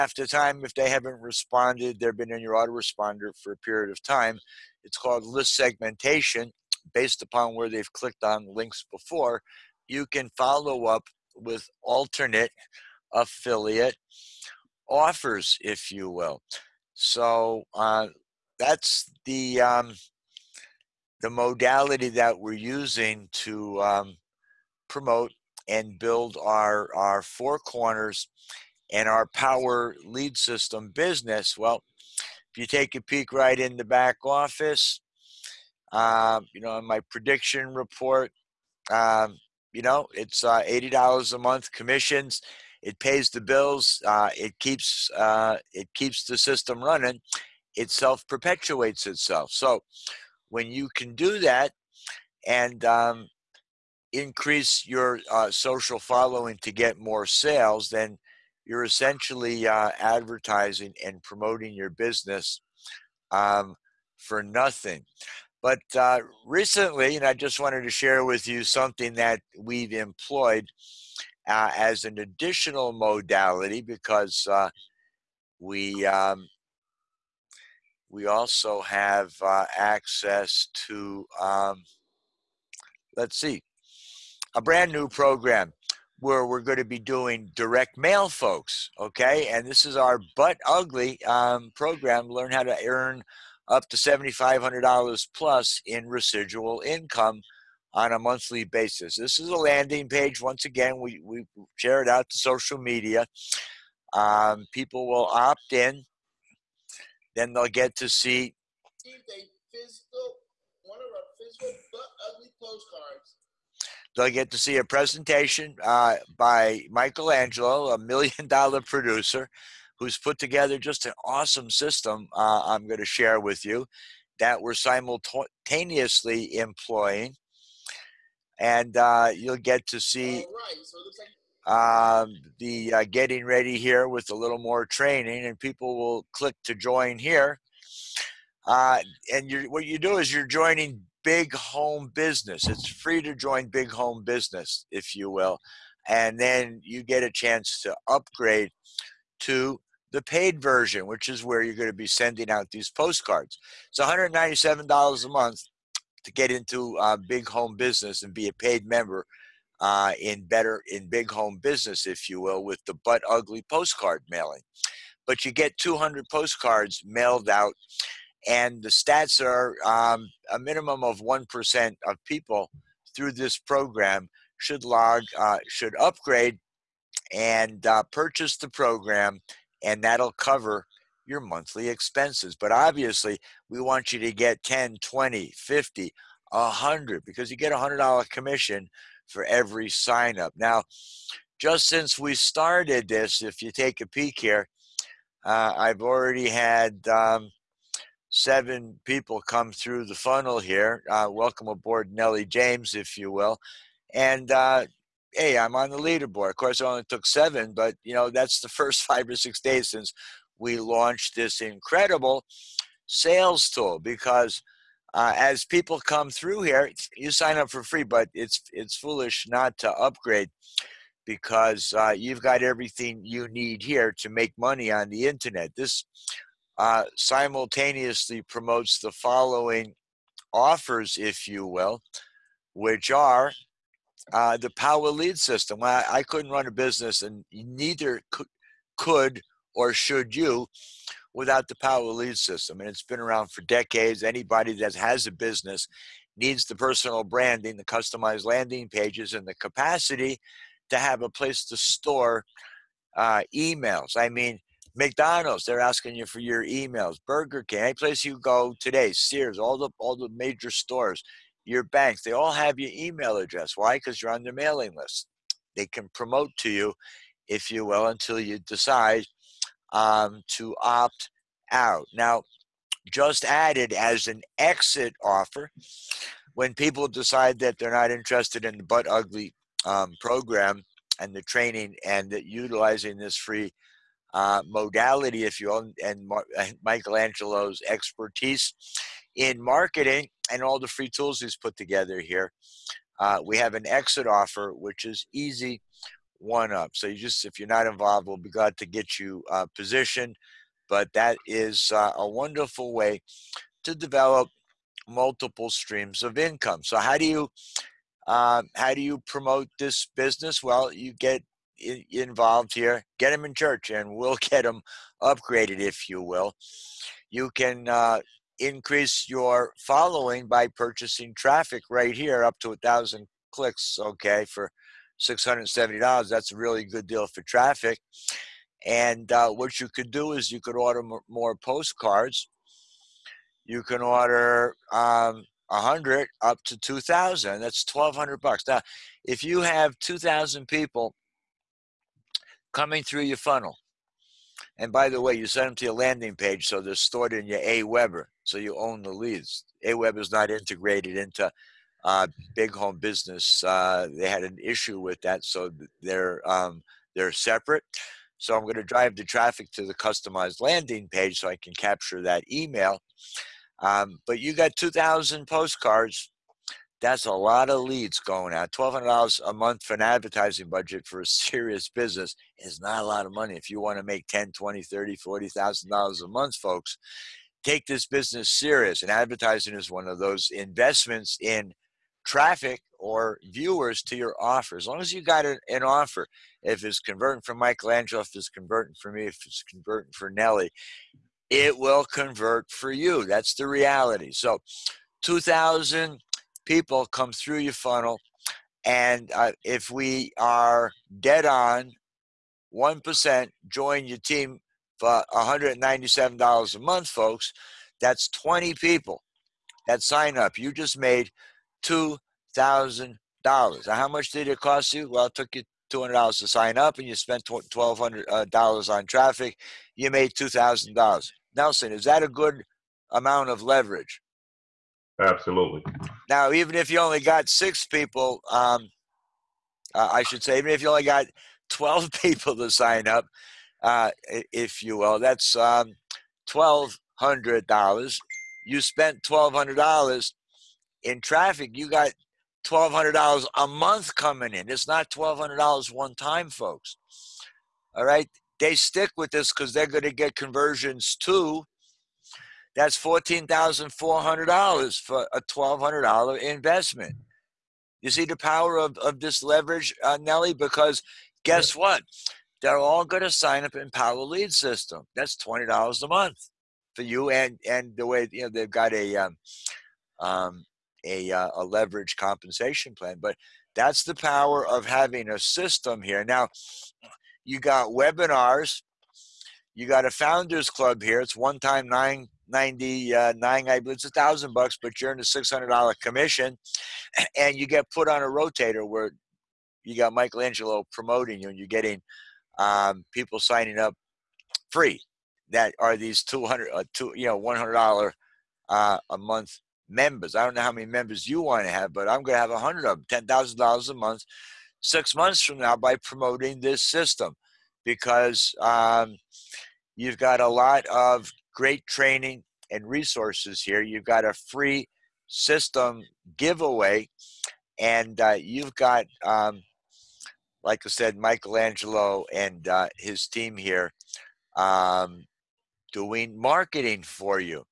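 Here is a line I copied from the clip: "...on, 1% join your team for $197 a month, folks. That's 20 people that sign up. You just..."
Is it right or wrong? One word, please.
right.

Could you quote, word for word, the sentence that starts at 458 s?
You see the power of, of this leverage, uh, Nelly?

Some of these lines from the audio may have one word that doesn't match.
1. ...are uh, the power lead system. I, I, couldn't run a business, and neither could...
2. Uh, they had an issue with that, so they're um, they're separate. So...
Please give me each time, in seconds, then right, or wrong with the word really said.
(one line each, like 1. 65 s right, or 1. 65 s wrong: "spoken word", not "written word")
1. 233 s right
2. 353 s right.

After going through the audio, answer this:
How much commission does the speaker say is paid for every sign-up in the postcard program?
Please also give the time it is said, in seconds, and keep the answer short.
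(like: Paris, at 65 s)
$100, at 187 s.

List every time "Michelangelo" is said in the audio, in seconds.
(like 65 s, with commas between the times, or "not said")
116 s, 286 s, 387 s, 490 s, 521 s.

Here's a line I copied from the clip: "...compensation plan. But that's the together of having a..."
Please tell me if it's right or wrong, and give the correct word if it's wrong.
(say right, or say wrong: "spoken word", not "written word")
wrong: "power", not "together".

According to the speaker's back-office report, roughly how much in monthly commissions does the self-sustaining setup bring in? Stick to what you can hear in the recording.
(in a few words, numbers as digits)
$80.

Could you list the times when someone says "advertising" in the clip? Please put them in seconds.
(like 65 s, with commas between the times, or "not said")
59 s, 370 s, 379 s.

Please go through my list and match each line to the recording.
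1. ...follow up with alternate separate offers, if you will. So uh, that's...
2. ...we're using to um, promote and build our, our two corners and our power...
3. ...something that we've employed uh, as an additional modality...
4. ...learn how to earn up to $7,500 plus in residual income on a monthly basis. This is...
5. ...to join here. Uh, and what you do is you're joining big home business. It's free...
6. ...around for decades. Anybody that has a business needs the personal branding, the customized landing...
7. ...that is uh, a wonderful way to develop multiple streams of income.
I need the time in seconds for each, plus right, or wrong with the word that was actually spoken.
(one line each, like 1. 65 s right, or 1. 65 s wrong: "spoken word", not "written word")
1. 10 s wrong: "affiliate", not "separate"
2. 22 s wrong: "four", not "two"
3. 68 s right
4. 92 s right
5. 136 s right
6. 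243 s right
7. 301 s right.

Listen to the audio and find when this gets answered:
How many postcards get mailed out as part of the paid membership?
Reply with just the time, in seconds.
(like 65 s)
165 s.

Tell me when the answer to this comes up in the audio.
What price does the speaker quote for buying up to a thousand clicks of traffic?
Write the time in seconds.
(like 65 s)
325 s.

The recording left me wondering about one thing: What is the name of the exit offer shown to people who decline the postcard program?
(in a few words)
Easy One Up.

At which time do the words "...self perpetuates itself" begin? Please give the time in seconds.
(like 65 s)
47 s.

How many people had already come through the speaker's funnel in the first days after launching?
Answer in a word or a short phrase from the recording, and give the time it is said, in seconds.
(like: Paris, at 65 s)
7, at 198 s.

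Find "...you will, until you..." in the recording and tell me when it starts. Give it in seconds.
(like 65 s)
267 s.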